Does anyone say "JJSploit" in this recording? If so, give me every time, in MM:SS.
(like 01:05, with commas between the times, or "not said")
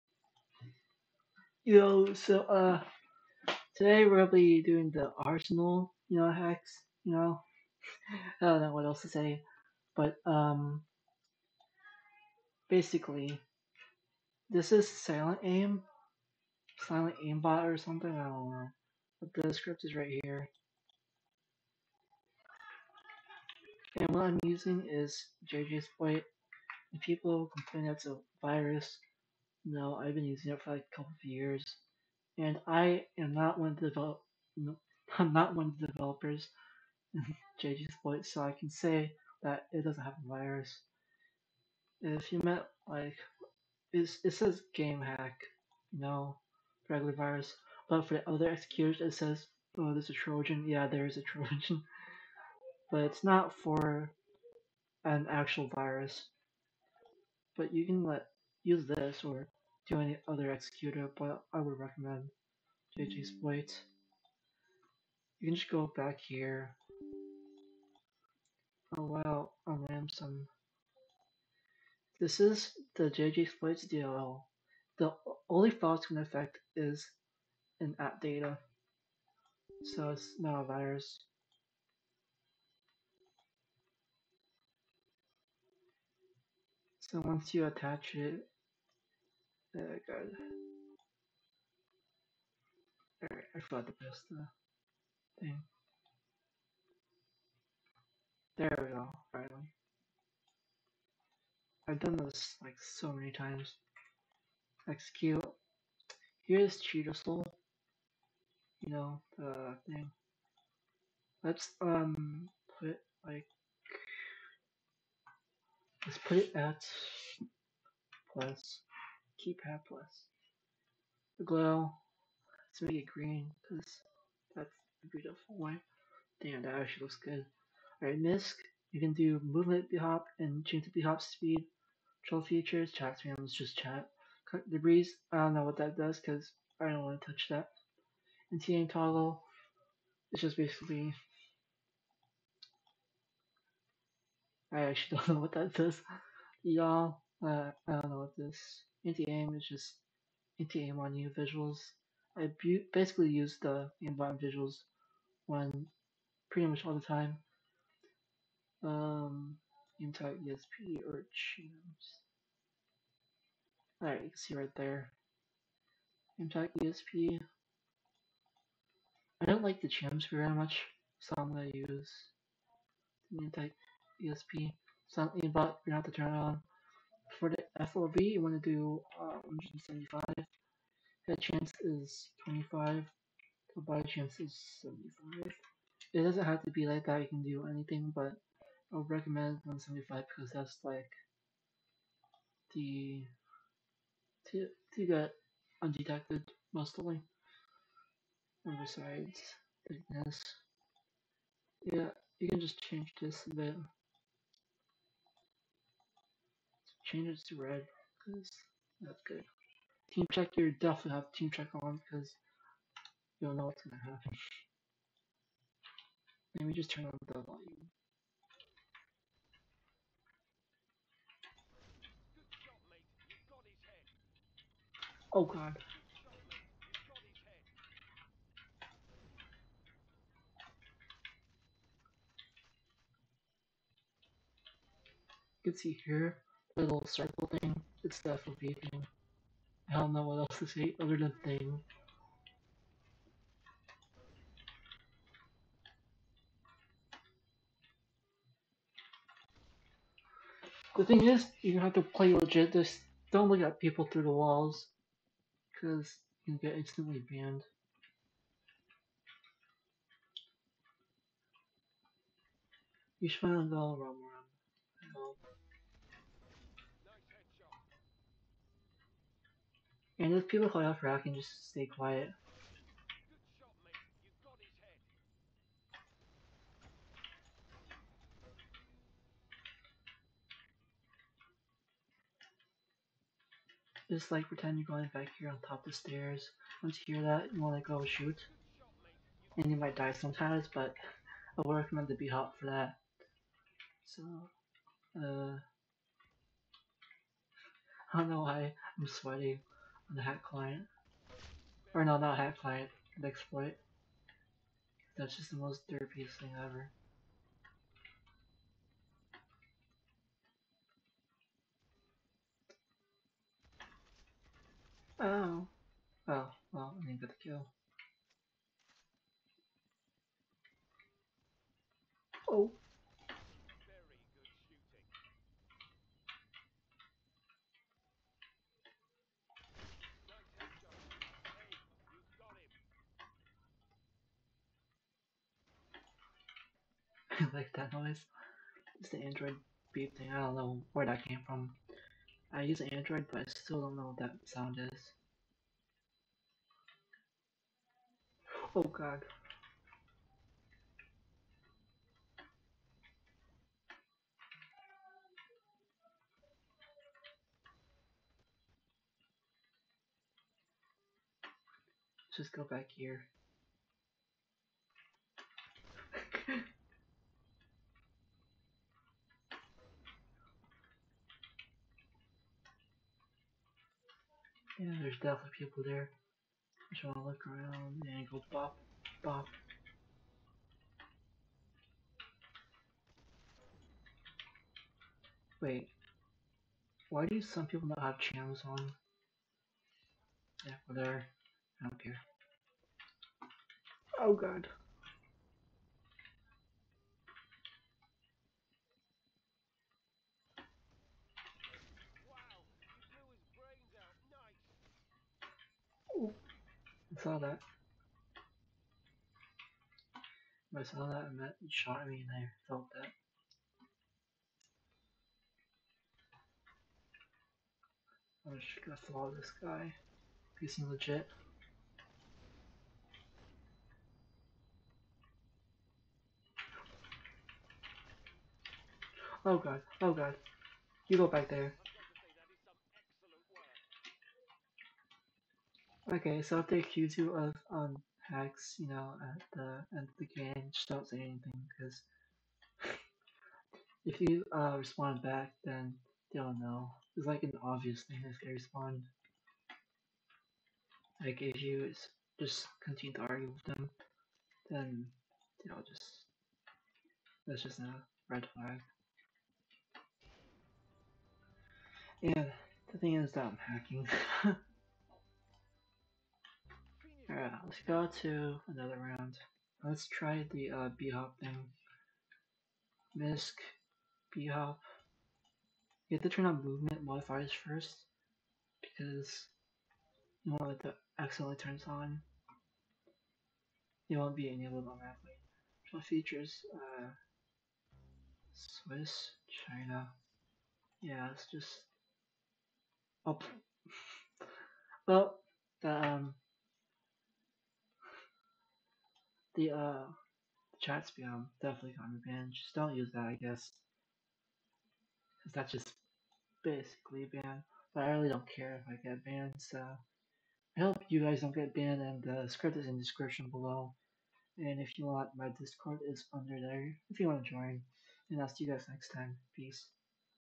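00:37, 01:02, 01:13.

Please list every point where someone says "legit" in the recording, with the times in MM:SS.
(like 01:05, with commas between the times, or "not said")
04:12, 07:00.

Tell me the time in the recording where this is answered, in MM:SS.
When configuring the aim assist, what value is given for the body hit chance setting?
03:04.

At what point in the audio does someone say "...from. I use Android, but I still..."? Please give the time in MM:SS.
05:41.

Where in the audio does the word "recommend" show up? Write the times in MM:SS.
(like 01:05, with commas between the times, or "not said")
01:01, 03:09, 04:51.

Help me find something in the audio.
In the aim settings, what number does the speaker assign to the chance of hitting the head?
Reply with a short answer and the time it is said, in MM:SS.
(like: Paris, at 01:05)
25, at 03:02.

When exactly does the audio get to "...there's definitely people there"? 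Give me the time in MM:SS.
06:14.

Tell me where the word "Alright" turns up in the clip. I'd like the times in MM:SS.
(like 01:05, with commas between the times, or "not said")
01:33, 02:08, 02:44, 07:47.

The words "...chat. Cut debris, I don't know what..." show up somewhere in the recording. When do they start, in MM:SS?
02:13.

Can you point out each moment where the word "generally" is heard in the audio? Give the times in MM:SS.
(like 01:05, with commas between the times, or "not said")
not said.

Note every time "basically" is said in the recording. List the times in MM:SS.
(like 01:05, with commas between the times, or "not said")
00:12, 02:20, 02:32, 08:26.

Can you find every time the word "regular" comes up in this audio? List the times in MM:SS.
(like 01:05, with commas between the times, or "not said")
00:46.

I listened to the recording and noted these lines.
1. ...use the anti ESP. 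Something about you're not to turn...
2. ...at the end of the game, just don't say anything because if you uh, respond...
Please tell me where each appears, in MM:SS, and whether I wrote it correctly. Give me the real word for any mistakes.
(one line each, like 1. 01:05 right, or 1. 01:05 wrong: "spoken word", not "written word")
1. 02:51 right
2. 07:19 right.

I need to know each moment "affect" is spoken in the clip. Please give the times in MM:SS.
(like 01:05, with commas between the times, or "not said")
01:16.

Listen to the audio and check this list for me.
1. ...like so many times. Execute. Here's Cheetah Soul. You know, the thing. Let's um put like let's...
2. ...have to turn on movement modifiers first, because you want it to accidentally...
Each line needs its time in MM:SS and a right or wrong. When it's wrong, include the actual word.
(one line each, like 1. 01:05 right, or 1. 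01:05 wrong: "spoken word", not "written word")
1. 01:42 right
2. 07:56 right.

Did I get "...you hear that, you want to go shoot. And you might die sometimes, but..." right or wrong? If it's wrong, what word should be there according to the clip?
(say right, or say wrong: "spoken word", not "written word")
right.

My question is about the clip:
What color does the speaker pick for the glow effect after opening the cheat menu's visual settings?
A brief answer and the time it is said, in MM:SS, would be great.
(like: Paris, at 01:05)
Green, at 02:03.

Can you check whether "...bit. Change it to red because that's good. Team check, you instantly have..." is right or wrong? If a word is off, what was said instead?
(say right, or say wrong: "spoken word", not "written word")
wrong: "definitely", not "instantly".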